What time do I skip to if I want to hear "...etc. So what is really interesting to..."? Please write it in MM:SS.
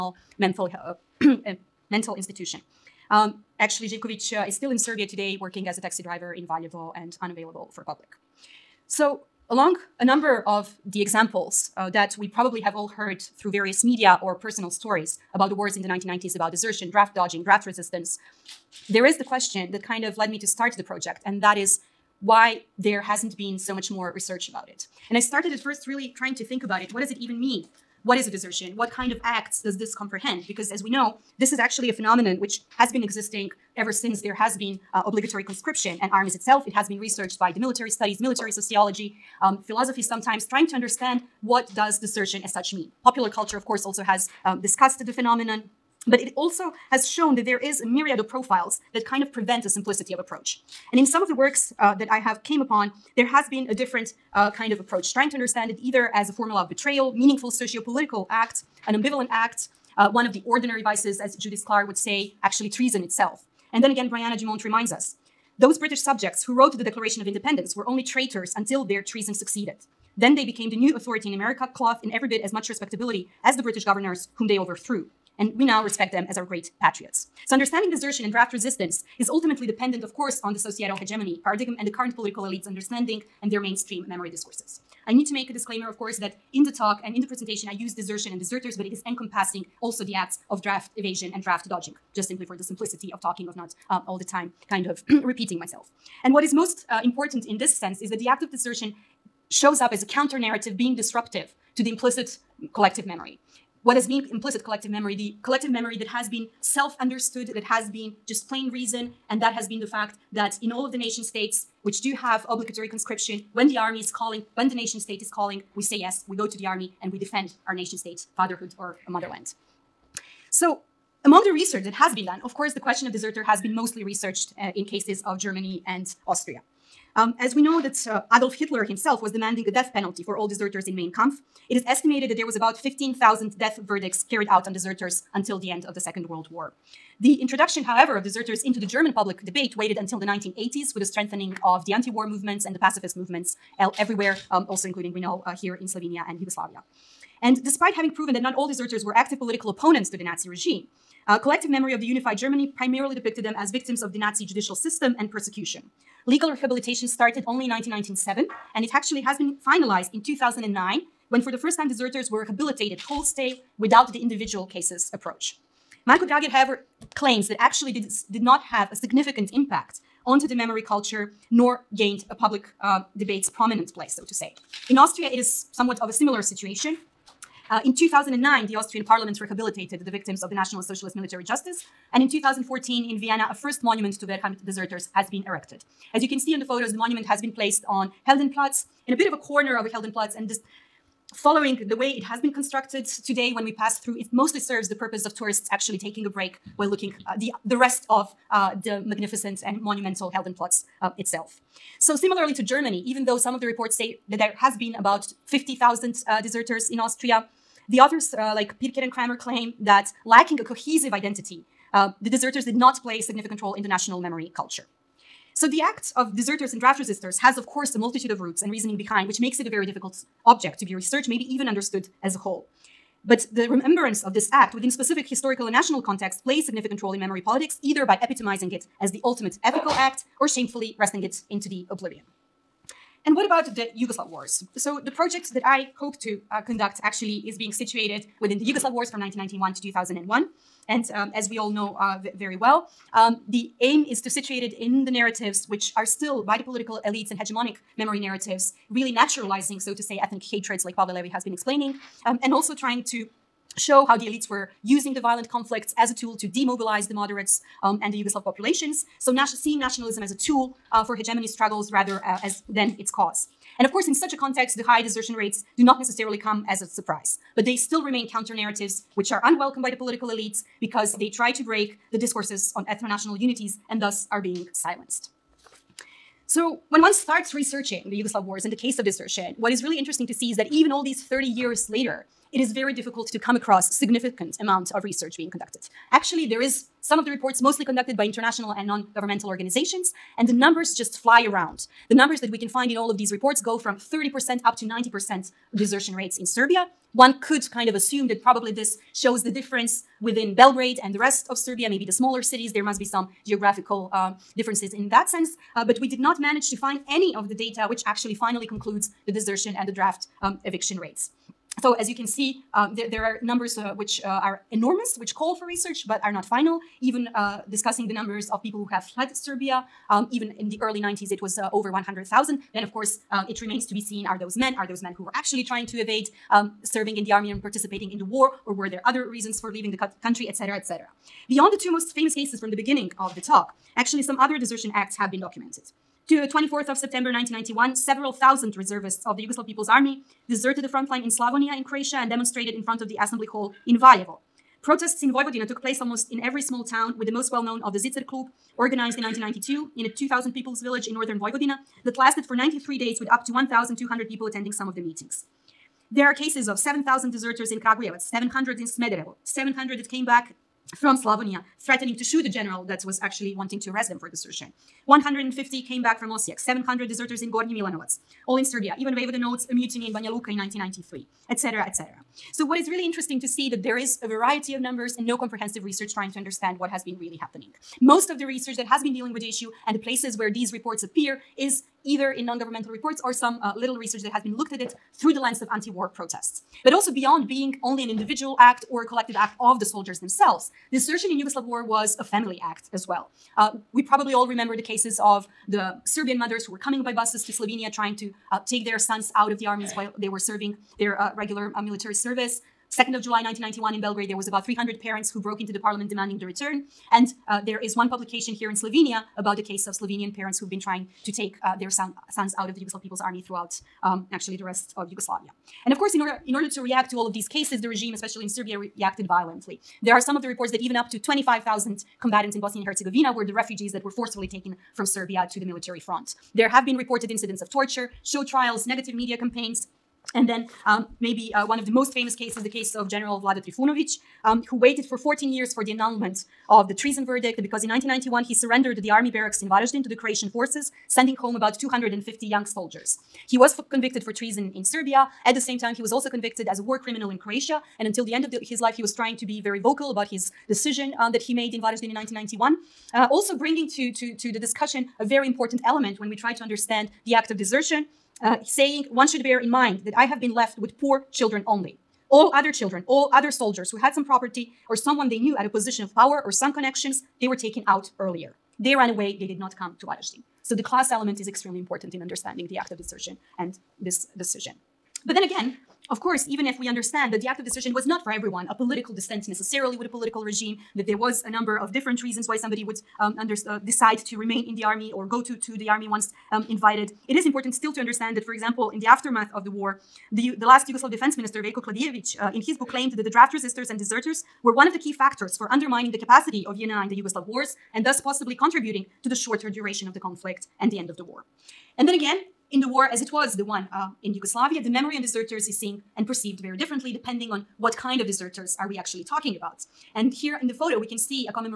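06:11.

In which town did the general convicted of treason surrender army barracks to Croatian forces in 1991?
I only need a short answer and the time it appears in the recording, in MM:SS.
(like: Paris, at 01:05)
Varazdin, at 07:19.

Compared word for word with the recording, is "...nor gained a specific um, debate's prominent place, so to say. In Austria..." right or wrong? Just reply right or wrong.
wrong.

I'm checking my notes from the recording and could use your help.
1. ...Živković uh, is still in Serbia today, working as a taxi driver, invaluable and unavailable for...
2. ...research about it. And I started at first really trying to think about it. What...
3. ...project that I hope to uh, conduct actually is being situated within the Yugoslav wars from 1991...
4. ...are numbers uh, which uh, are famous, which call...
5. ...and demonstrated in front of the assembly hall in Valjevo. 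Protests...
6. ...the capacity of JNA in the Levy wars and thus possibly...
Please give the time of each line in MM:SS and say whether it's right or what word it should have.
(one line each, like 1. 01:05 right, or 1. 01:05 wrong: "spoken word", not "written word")
1. 00:03 right
2. 00:24 right
3. 03:55 right
4. 05:13 wrong: "enormous", not "famous"
5. 05:42 right
6. 08:16 wrong: "Yugoslav", not "Levy".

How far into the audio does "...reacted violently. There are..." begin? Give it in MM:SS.
06:58.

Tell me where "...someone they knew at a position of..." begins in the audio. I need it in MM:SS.
07:44.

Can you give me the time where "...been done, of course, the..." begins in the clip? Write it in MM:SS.
02:02.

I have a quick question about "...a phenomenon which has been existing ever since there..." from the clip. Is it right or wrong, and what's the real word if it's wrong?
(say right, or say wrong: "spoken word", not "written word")
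right.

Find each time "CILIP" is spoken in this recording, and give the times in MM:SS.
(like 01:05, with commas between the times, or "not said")
not said.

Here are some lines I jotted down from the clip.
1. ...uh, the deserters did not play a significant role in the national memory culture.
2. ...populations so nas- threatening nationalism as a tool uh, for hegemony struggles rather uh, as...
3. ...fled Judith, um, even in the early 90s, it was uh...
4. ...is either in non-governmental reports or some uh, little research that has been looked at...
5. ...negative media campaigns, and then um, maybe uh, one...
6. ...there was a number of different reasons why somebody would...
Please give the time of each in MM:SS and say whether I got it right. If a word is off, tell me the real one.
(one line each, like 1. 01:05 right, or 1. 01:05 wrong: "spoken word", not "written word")
1. 03:31 right
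2. 04:18 wrong: "seeing", not "threatening"
3. 05:19 wrong: "Serbia", not "Judith"
4. 06:21 right
5. 07:08 right
6. 08:01 right.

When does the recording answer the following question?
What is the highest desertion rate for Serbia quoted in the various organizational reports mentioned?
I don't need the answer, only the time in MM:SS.
04:54.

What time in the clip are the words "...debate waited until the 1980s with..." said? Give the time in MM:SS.
02:19.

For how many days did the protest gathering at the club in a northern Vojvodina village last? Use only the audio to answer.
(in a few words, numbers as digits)
93 days.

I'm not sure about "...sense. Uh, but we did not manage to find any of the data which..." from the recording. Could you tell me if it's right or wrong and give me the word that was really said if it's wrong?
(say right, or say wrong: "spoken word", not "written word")
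right.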